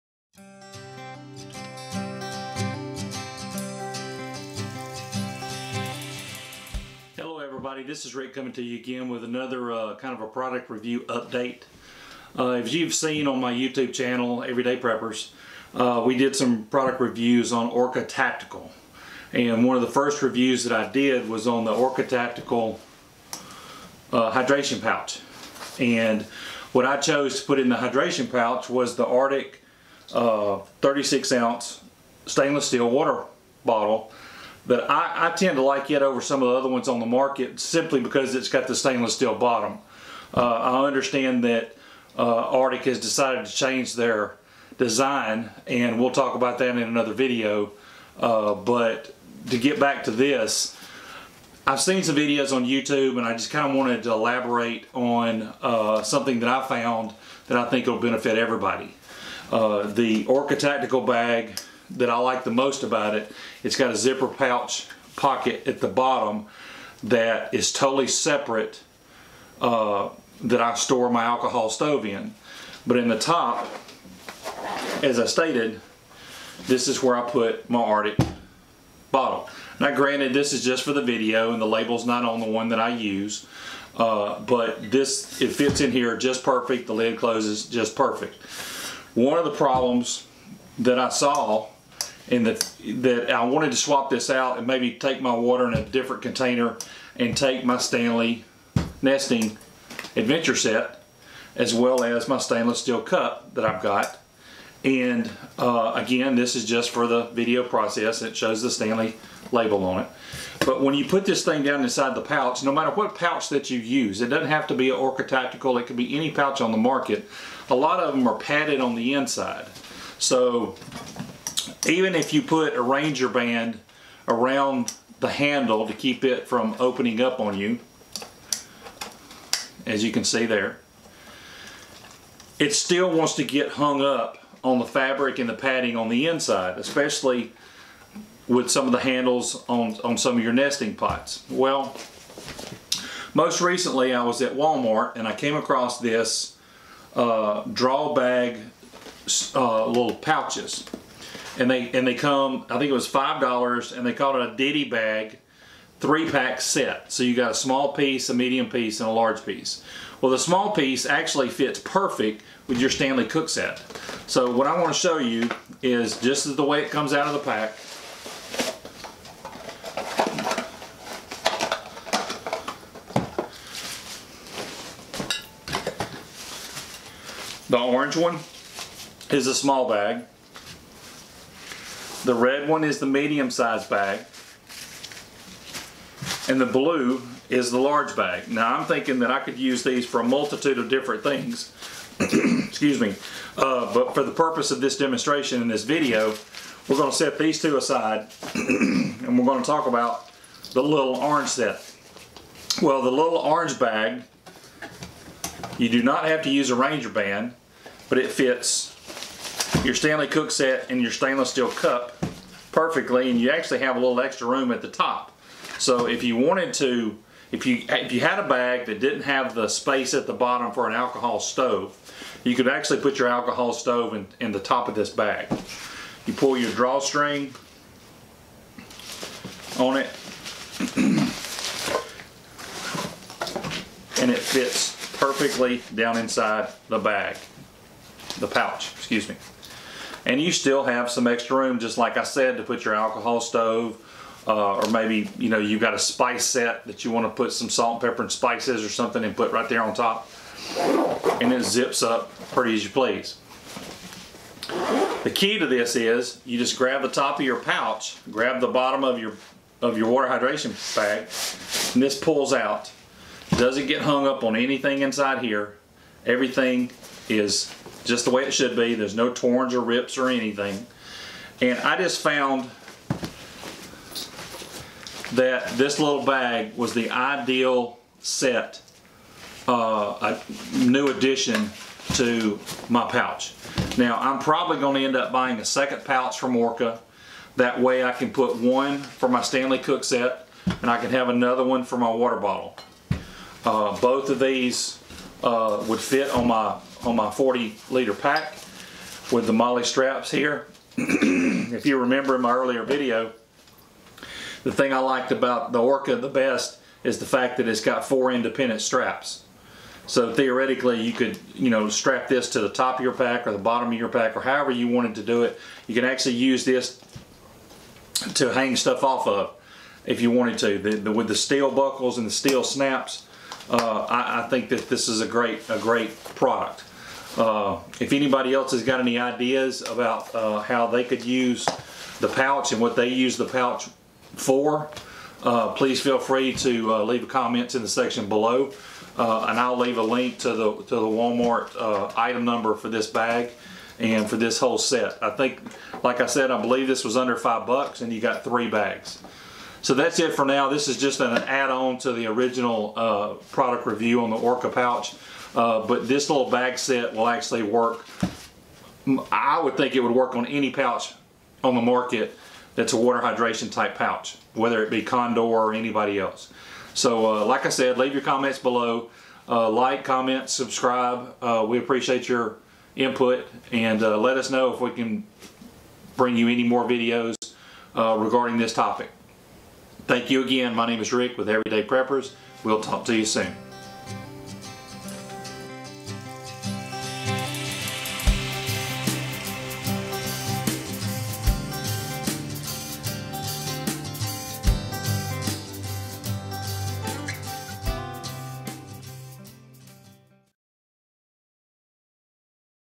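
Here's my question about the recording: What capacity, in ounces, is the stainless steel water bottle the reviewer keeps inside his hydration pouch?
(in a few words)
36 ounce.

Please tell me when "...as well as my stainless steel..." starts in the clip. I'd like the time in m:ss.
1:41.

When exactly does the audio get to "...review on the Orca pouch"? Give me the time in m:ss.
5:53.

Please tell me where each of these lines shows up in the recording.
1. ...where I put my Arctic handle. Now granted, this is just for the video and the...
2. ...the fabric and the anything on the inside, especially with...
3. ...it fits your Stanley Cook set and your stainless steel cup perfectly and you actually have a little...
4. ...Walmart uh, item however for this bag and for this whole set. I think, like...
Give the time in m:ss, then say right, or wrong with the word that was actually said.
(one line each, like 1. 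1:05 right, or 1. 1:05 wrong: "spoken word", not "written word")
1. 1:17 wrong: "bottle", not "handle"
2. 2:14 wrong: "padding", not "anything"
3. 3:28 right
4. 5:41 wrong: "number", not "however".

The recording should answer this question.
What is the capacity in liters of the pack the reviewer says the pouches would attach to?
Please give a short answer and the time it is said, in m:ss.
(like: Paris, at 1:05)
40 liter, at 4:57.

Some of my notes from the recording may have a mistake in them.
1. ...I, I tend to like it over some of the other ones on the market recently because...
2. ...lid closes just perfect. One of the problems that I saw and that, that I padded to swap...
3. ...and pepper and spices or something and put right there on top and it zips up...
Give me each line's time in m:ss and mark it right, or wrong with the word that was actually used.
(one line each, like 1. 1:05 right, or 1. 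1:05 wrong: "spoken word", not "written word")
1. 0:34 wrong: "simply", not "recently"
2. 1:26 wrong: "wanted", not "padded"
3. 4:08 right.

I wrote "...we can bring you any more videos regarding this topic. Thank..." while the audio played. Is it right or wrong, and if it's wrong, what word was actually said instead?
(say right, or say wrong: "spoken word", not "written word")
right.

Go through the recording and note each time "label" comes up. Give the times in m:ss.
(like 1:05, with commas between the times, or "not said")
1:21, 1:49.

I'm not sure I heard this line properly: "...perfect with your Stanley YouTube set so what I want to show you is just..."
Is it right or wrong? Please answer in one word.
wrong.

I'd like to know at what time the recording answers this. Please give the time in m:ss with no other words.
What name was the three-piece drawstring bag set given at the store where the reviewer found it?
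2:34.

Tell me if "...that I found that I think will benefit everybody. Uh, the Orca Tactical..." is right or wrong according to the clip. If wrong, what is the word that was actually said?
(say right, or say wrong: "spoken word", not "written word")
right.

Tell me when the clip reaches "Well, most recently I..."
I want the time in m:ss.
2:21.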